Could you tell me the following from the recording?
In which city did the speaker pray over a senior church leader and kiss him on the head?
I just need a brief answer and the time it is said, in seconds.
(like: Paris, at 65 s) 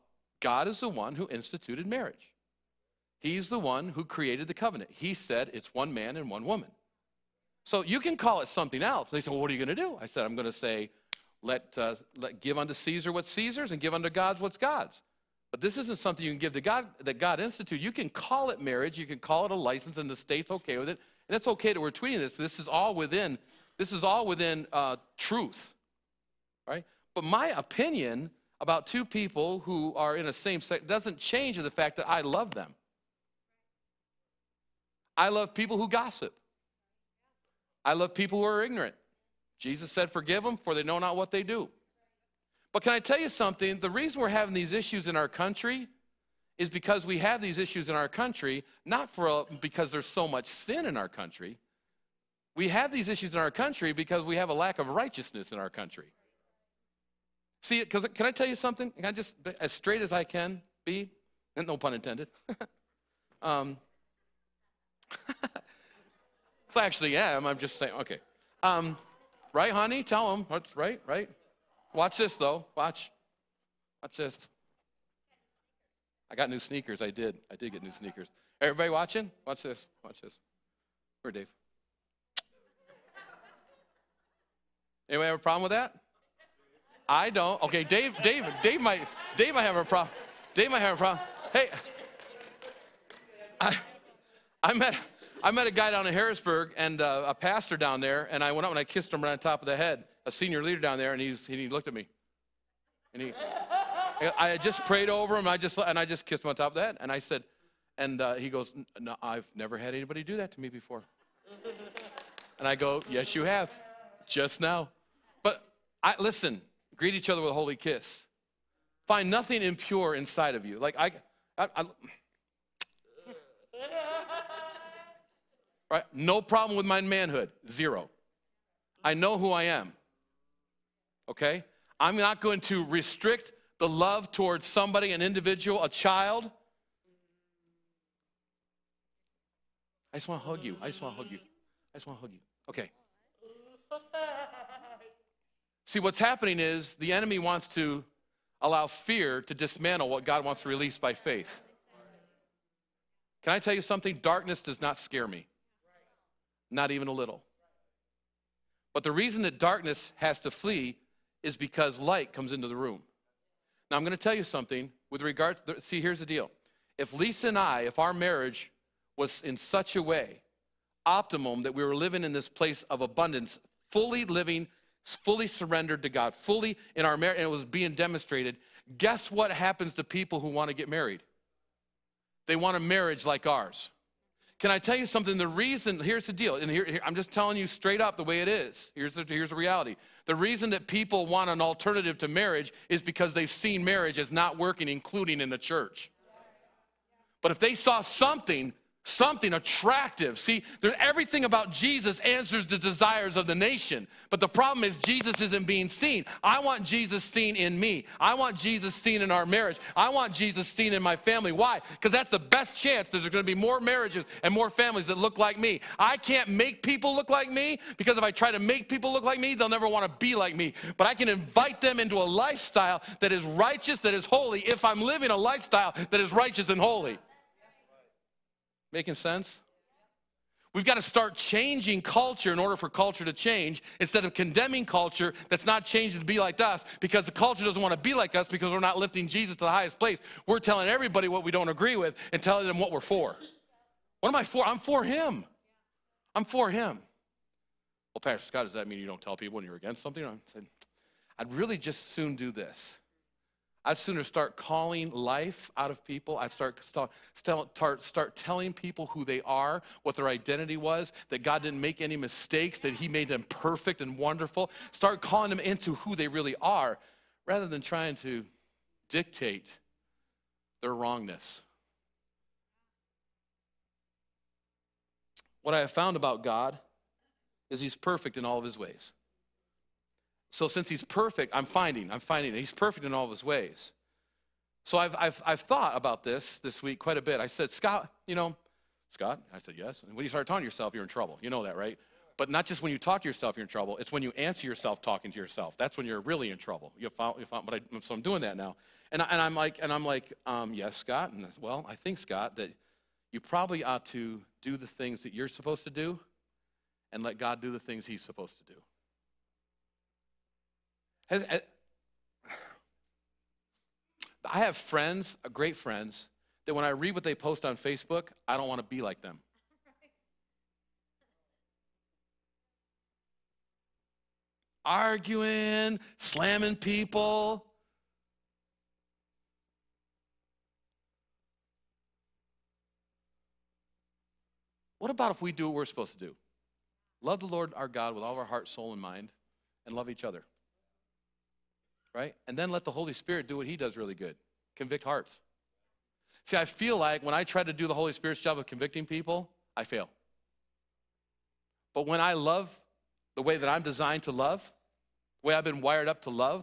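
Harrisburg, at 96 s.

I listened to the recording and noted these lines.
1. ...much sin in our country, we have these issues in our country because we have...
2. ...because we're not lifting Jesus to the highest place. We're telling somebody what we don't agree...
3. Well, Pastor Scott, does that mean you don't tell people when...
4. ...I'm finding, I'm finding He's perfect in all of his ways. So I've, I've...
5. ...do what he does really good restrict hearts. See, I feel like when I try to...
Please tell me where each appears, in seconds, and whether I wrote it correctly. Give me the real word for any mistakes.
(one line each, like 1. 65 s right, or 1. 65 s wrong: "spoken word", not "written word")
1. 50 s right
2. 238 s wrong: "everybody", not "somebody"
3. 248 s right
4. 281 s right
5. 343 s wrong: "convict", not "restrict".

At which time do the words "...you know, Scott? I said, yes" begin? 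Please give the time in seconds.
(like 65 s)
288 s.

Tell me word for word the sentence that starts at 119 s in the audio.
Find nothing impure inside of you.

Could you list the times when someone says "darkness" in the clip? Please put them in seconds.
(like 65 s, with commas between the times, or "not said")
154 s, 159 s.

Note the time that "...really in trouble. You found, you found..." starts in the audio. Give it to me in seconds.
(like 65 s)
296 s.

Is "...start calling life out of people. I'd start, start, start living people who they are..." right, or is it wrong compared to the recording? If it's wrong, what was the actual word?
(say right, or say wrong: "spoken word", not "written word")
wrong: "telling", not "living".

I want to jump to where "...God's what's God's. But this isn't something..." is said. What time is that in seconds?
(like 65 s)
14 s.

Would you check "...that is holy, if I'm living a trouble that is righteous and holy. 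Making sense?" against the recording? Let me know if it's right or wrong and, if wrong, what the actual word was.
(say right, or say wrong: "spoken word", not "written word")
wrong: "lifestyle", not "trouble".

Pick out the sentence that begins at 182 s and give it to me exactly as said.
They want a marriage like ours.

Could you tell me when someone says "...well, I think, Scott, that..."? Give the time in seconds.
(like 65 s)
301 s.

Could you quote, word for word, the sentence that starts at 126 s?
No problem with my manhood, zero.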